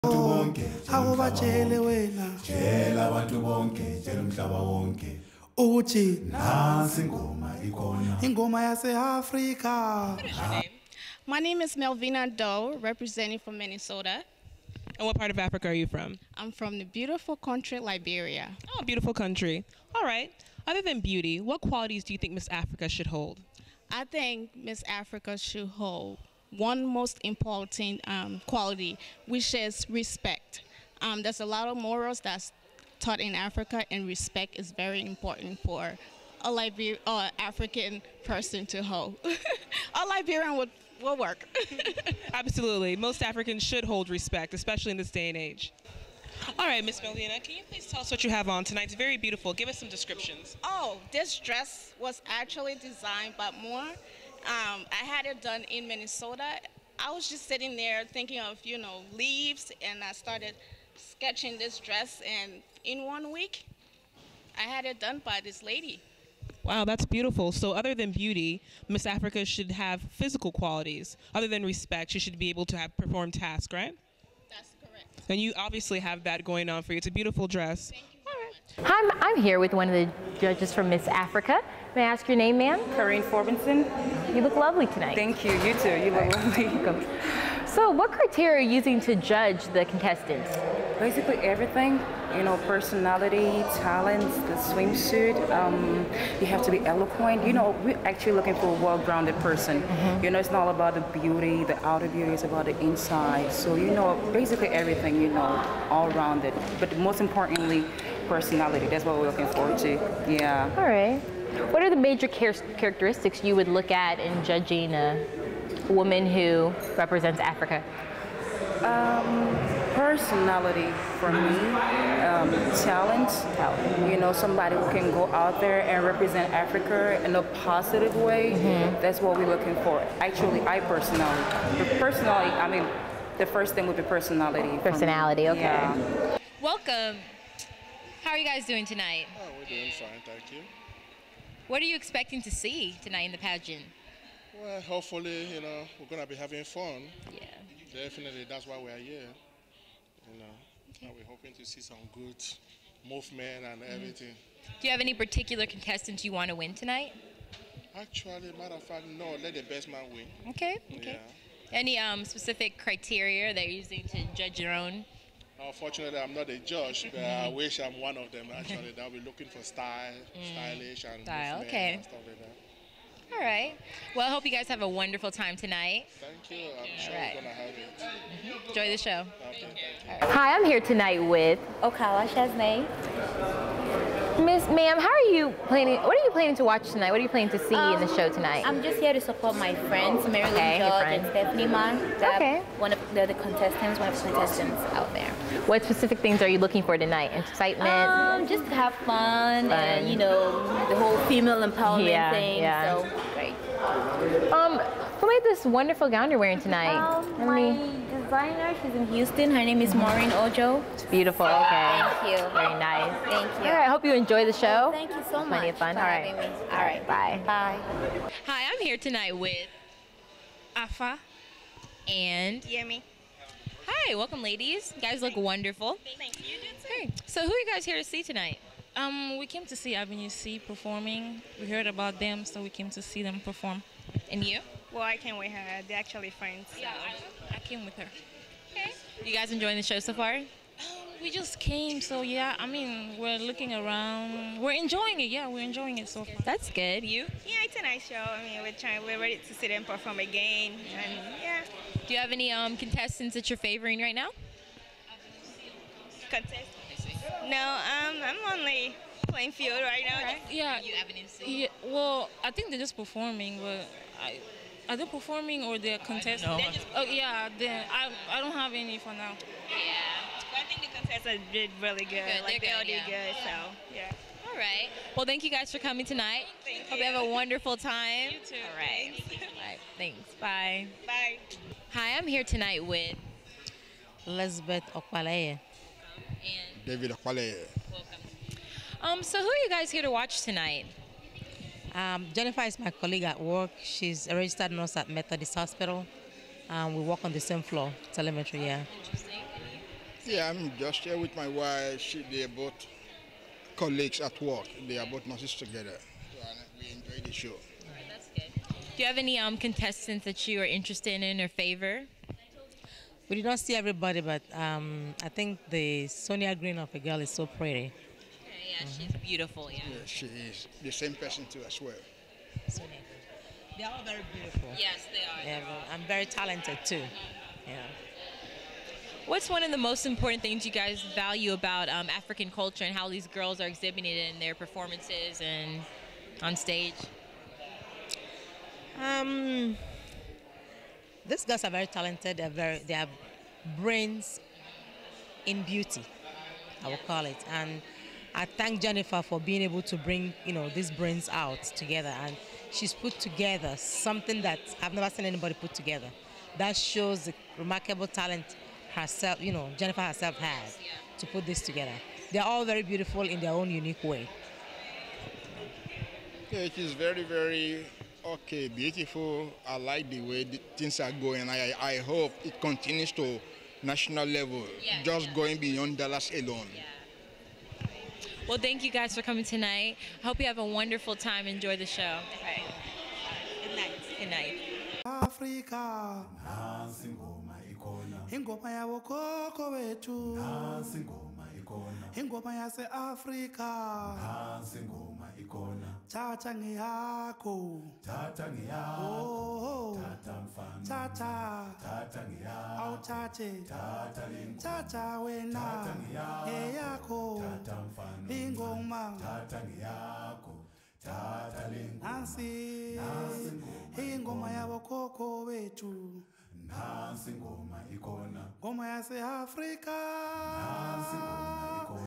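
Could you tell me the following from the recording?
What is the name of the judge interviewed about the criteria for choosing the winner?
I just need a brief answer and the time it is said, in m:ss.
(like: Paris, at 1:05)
Corrine Forbinson, at 1:22.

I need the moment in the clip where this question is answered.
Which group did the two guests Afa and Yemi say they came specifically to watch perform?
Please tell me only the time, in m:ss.
3:49.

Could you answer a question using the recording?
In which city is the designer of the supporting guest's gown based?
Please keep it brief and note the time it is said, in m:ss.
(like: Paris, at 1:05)
Houston, at 3:29.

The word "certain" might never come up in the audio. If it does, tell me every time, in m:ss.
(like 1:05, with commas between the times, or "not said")
not said.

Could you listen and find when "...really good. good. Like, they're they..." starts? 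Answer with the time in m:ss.
4:31.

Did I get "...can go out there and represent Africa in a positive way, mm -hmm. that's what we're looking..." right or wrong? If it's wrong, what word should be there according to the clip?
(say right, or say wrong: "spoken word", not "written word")
right.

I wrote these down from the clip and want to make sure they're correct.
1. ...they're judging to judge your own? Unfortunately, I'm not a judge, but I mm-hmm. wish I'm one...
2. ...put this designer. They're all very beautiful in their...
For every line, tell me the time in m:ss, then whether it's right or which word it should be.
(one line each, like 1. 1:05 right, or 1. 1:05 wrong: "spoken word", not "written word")
1. 2:43 wrong: "using", not "judging"
2. 6:01 wrong: "together", not "designer".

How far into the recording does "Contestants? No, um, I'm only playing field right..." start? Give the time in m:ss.
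4:16.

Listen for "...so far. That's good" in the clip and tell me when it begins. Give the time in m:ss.
4:06.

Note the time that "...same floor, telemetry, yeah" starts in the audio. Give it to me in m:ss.
4:57.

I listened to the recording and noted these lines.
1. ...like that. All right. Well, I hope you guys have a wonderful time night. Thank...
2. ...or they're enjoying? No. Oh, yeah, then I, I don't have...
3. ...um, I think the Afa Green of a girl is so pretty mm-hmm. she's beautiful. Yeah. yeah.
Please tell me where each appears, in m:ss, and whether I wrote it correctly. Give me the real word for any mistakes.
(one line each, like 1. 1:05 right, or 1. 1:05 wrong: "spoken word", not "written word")
1. 2:52 wrong: "tonight", not "night"
2. 4:25 wrong: "contesting", not "enjoying"
3. 5:14 wrong: "Sonia", not "Afa".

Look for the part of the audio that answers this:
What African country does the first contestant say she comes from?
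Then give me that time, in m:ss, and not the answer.
0:17.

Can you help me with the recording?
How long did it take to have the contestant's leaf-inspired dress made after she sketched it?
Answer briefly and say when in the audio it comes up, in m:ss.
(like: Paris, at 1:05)
One week, at 1:02.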